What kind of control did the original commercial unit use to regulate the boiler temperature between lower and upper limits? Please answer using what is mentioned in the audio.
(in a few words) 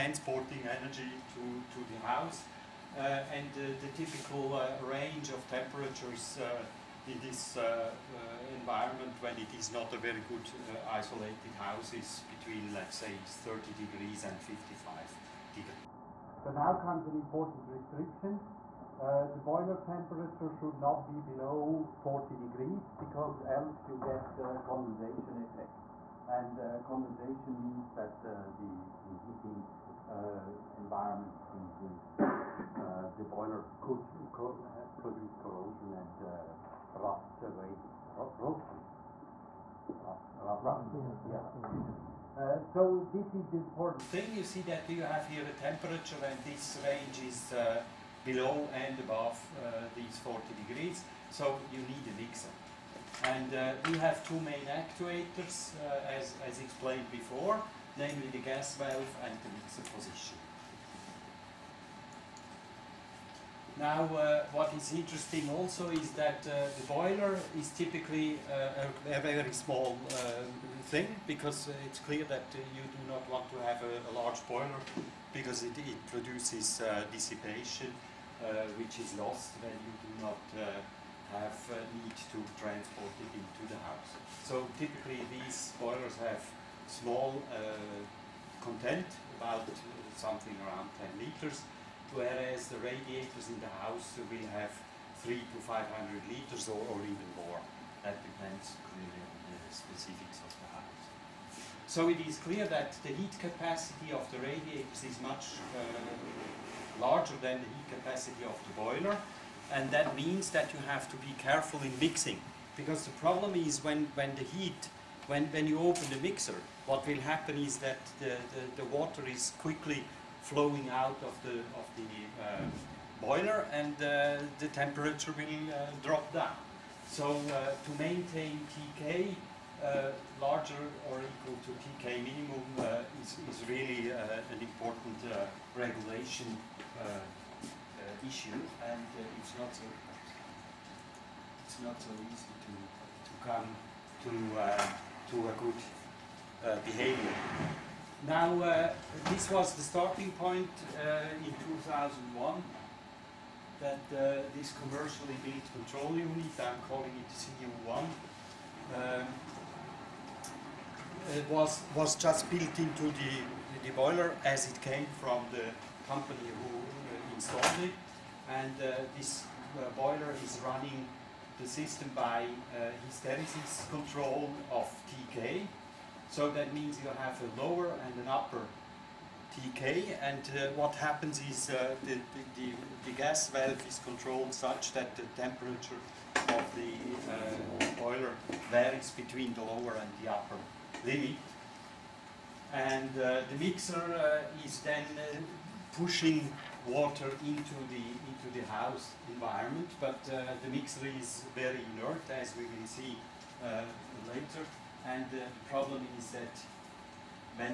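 Hysteresis control.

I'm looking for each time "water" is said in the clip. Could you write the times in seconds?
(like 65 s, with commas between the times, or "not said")
118 s, 196 s.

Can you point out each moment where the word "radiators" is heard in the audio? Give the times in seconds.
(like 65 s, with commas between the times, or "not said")
92 s, 104 s.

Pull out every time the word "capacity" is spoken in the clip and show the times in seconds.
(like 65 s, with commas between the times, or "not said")
103 s, 107 s.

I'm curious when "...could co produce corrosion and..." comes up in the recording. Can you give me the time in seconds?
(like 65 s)
33 s.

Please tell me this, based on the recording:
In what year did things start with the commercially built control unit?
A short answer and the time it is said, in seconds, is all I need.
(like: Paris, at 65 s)
2001, at 151 s.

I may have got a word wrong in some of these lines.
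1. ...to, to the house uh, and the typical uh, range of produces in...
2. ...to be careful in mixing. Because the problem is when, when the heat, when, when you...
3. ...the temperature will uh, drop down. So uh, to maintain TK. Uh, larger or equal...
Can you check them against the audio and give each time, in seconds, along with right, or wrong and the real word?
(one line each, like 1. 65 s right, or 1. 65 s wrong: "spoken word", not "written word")
1. 1 s wrong: "temperatures", not "produces"
2. 111 s right
3. 124 s right.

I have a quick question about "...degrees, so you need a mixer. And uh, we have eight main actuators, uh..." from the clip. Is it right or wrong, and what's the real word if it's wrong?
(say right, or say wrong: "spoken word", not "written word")
wrong: "two", not "eight".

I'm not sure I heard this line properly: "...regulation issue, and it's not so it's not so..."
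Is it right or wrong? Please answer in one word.
right.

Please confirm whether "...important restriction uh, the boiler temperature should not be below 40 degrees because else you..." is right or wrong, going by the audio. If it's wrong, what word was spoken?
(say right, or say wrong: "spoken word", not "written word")
right.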